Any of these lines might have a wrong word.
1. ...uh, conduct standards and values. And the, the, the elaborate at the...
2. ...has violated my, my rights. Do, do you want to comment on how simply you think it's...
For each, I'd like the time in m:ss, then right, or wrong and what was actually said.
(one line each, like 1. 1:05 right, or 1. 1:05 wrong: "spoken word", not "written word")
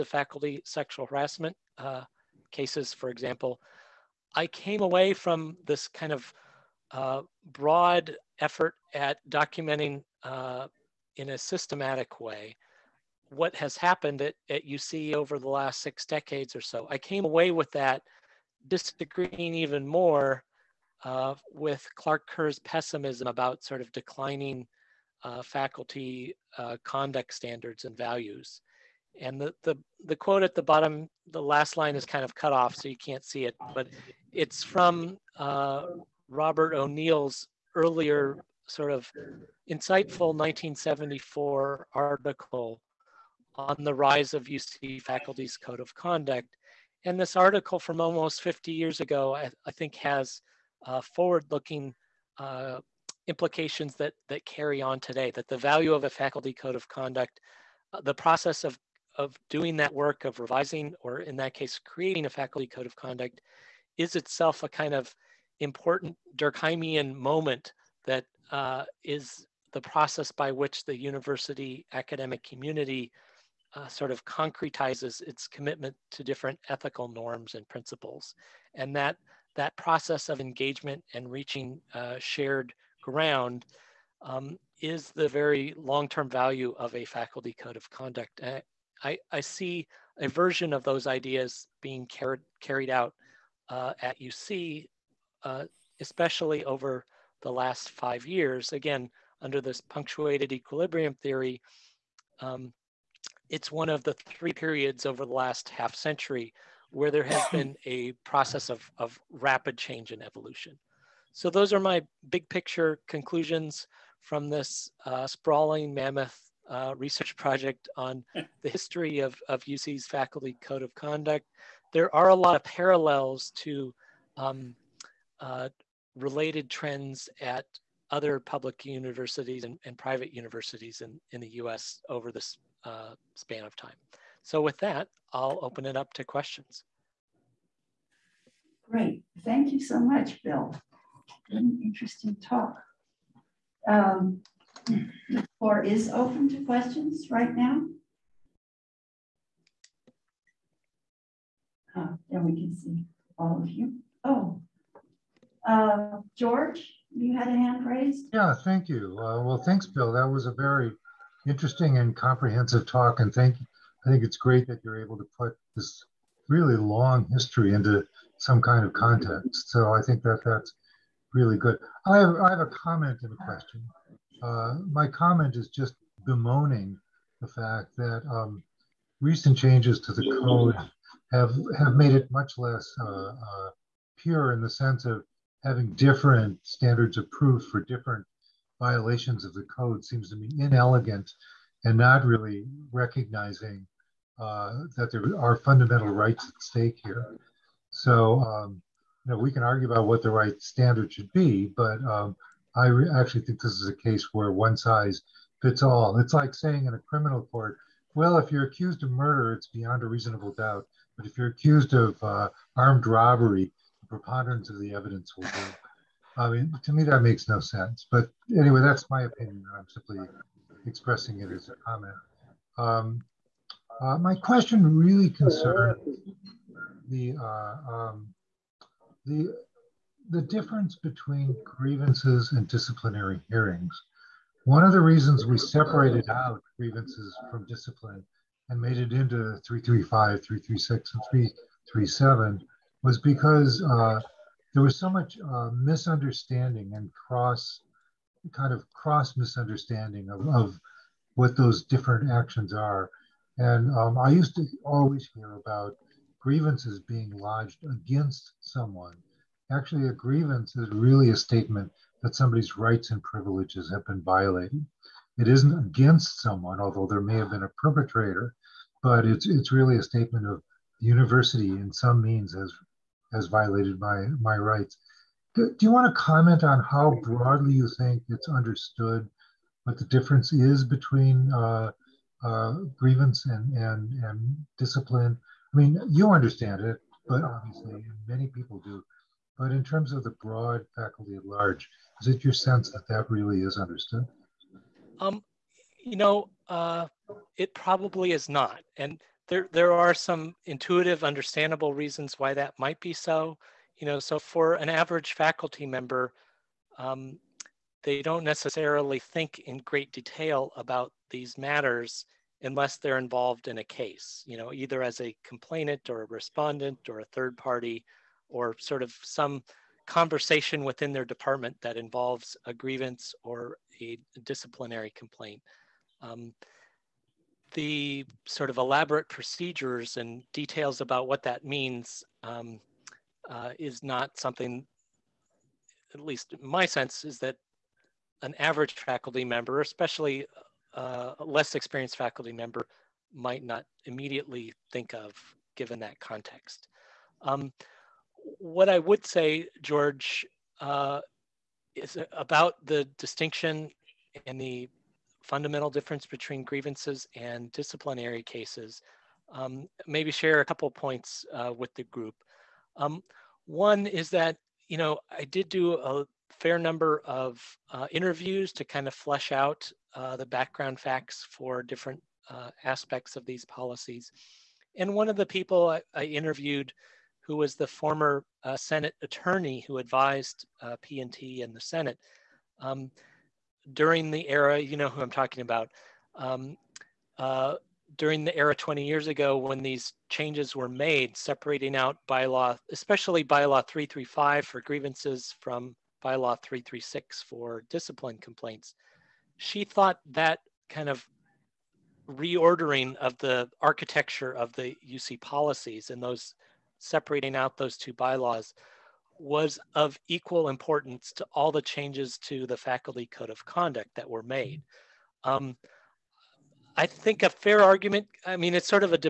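1. 0:26 wrong: "quote", not "elaborate"
2. 4:33 wrong: "broadly", not "simply".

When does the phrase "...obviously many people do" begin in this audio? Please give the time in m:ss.
4:47.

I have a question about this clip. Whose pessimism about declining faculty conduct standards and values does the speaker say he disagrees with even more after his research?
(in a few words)
Clark Kerr.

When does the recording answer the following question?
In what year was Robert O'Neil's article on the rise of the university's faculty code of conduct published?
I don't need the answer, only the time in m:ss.
0:40.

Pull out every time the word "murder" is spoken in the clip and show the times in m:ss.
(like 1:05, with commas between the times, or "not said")
3:29.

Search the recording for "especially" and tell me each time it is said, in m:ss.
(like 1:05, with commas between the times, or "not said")
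1:36, 5:39, 6:32.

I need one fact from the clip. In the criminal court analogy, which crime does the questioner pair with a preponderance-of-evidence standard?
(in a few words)
armed robbery.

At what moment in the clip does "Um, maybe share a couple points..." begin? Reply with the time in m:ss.
5:59.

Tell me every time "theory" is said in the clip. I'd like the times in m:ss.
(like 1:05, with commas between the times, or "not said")
1:41.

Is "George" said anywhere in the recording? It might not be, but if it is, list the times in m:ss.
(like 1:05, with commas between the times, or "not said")
2:36, 5:49.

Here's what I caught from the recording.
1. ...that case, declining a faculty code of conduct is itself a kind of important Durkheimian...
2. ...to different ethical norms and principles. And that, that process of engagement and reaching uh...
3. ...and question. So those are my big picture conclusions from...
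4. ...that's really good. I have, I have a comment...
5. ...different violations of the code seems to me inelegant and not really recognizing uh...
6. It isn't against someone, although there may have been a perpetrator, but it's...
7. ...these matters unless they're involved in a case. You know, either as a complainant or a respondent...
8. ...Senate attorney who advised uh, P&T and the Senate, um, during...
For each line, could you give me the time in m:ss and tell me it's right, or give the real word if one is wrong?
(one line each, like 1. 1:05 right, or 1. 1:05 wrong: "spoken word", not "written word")
1. 1:01 wrong: "creating", not "declining"
2. 1:16 right
3. 1:50 wrong: "evolution", not "question"
4. 2:50 right
5. 3:07 right
6. 4:25 right
7. 5:11 right
8. 6:18 right.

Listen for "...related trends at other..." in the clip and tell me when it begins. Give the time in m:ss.
2:06.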